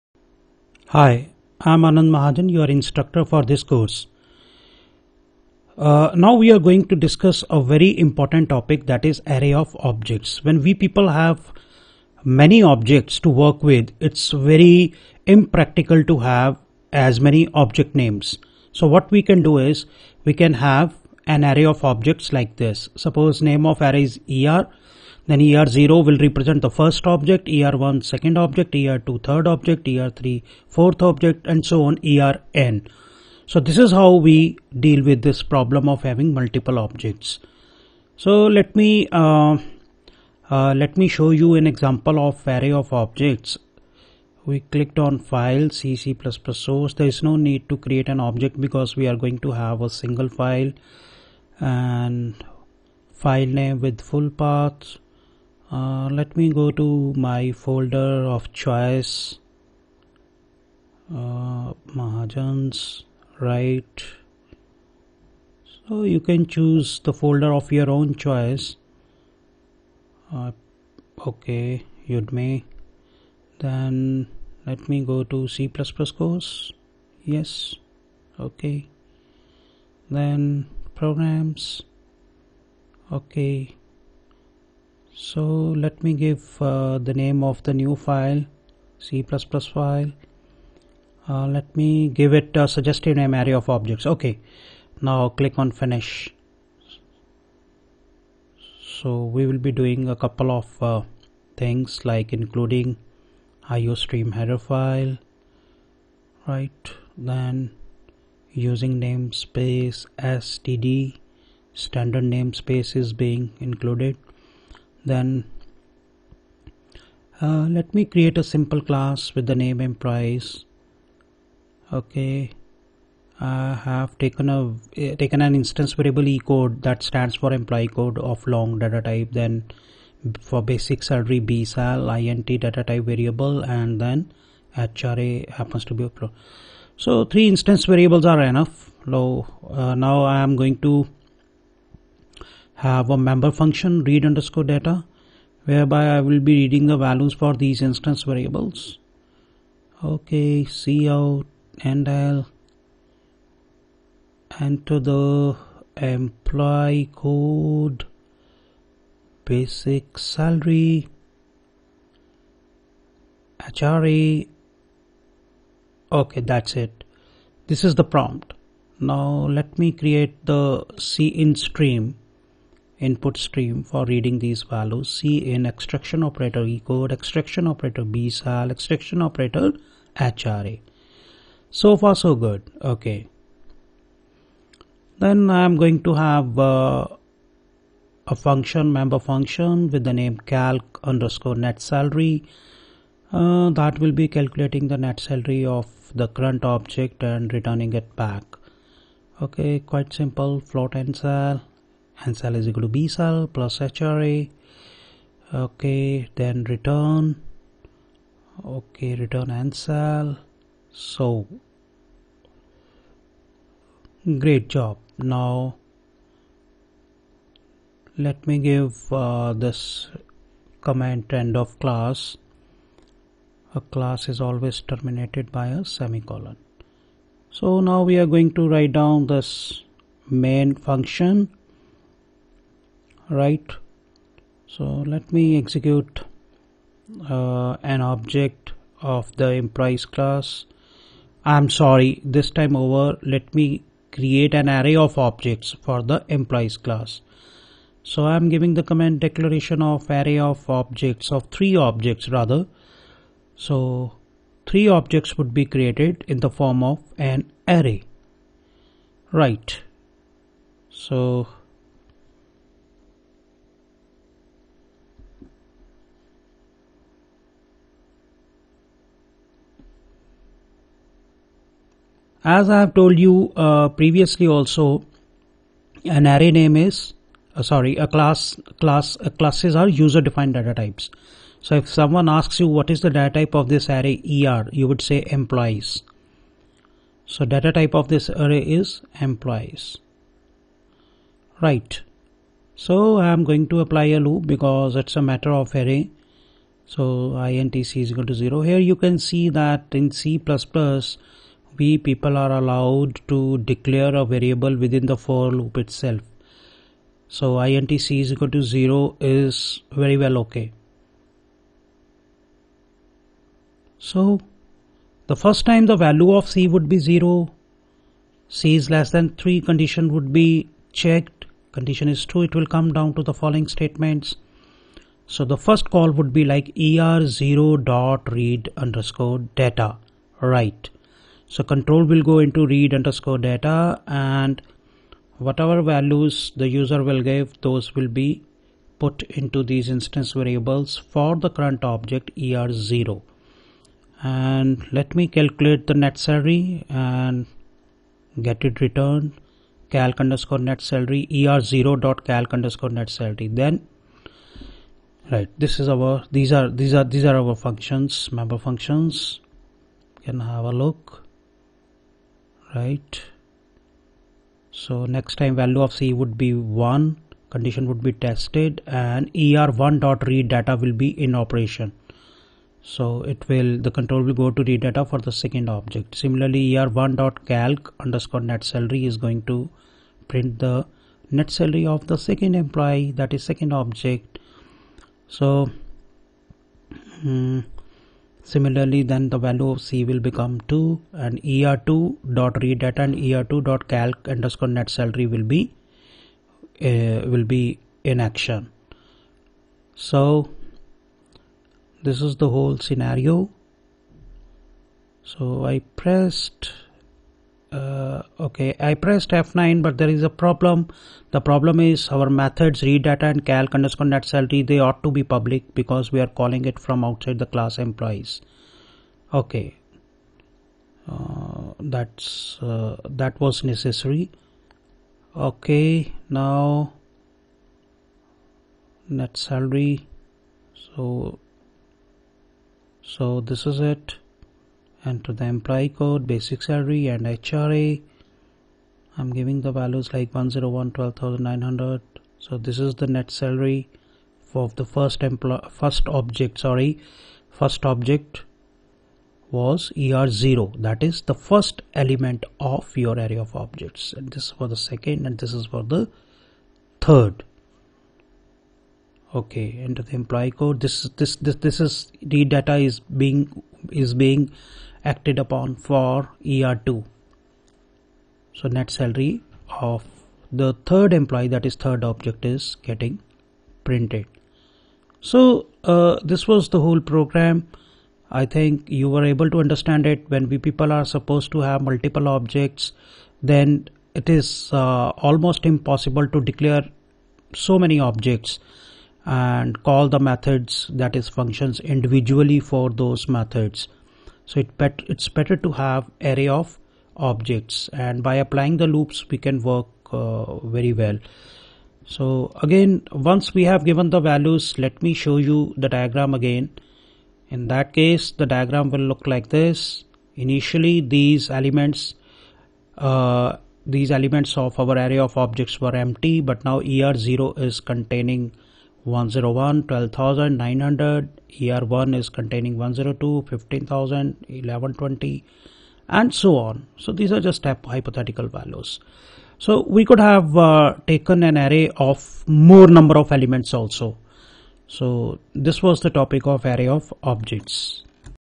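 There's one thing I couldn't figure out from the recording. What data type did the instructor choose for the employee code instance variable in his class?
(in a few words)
long.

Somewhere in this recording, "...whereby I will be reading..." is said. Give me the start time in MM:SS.
02:25.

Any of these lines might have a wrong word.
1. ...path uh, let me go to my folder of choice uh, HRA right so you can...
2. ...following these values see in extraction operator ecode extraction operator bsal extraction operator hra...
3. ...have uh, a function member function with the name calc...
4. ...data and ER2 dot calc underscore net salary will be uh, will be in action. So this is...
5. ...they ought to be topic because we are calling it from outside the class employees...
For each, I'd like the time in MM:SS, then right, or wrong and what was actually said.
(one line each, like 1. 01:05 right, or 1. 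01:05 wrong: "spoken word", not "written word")
1. 00:54 wrong: "Mahajans", not "HRA"
2. 02:54 wrong: "reading", not "following"
3. 03:06 right
4. 06:32 right
5. 06:54 wrong: "public", not "topic".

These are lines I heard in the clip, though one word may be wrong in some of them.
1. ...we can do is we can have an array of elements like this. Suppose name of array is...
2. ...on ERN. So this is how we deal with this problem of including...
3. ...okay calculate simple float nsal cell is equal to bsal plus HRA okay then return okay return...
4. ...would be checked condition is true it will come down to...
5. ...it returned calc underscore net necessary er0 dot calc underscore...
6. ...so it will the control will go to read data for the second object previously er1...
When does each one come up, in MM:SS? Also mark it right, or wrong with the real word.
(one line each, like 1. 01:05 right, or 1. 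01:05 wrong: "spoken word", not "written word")
1. 00:19 wrong: "objects", not "elements"
2. 00:31 wrong: "having", not "including"
3. 03:19 wrong: "quite", not "calculate"
4. 05:20 right
5. 05:48 wrong: "salary", not "necessary"
6. 06:12 wrong: "similarly", not "previously".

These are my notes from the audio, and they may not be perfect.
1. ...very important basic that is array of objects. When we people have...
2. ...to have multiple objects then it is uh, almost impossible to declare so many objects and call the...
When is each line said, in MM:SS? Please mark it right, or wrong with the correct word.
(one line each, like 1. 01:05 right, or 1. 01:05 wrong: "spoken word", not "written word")
1. 00:07 wrong: "topic", not "basic"
2. 08:01 right.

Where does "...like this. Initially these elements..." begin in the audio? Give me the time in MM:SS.
08:29.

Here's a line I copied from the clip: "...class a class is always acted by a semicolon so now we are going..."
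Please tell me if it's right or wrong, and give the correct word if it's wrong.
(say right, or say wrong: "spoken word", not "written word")
wrong: "terminated", not "acted".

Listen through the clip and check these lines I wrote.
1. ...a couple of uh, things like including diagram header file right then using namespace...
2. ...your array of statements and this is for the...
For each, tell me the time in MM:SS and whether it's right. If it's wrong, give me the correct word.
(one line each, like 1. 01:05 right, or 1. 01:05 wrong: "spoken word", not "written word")
1. 01:40 wrong: "iostream", not "diagram"
2. 07:32 wrong: "objects", not "statements".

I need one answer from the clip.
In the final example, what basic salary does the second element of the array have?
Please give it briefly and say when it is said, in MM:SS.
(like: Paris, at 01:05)
15000, at 08:43.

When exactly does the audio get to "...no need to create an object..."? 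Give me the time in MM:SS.
00:47.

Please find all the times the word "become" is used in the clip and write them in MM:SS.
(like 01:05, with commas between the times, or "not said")
06:30.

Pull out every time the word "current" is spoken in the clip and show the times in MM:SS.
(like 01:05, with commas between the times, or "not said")
03:16, 05:41.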